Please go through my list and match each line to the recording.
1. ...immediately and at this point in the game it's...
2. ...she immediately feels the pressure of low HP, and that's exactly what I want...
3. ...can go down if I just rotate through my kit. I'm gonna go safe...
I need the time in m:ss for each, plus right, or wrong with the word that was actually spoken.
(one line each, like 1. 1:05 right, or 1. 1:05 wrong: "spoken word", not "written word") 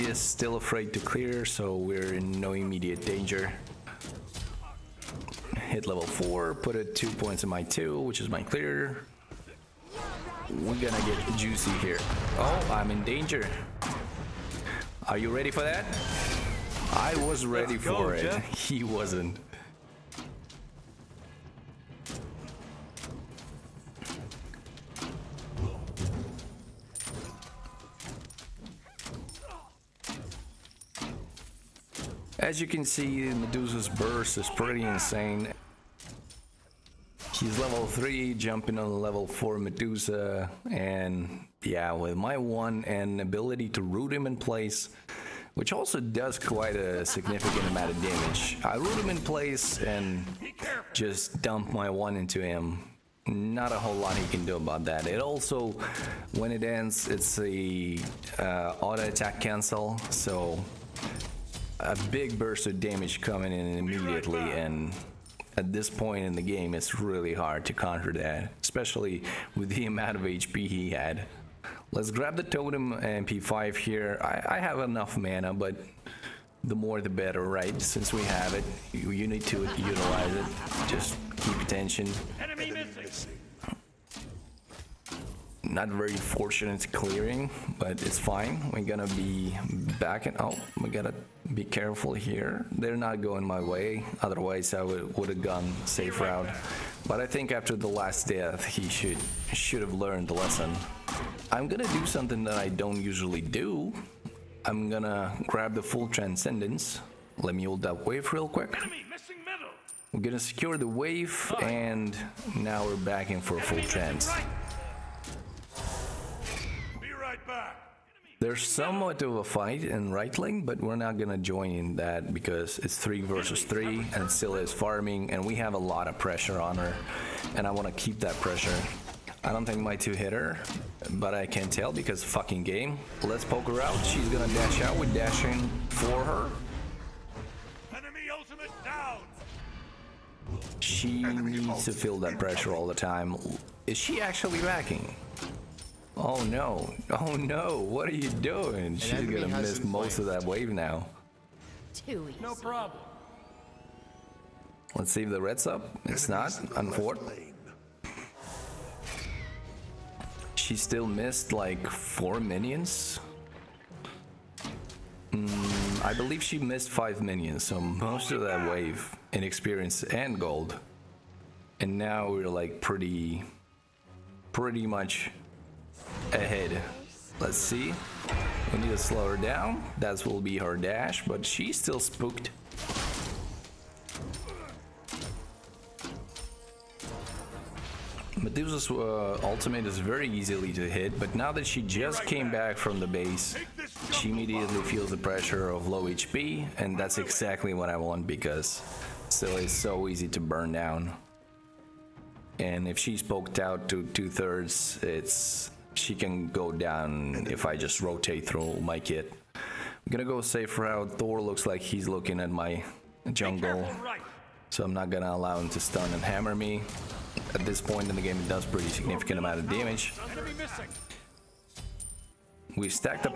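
1. 1:03 right
2. 3:14 right
3. 3:26 right.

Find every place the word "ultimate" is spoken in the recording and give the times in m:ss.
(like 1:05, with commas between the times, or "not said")
2:18, 3:09.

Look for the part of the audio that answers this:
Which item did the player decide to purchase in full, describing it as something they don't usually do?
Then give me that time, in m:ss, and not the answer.
1:45.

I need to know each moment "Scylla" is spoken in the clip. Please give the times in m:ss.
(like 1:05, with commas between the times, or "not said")
2:04, 3:19.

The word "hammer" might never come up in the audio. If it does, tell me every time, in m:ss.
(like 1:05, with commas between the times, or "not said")
3:36.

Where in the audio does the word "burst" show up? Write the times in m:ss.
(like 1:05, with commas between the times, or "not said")
0:33, 1:02.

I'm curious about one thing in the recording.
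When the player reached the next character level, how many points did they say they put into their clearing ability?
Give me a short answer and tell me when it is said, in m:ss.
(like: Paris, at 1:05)
2, at 0:06.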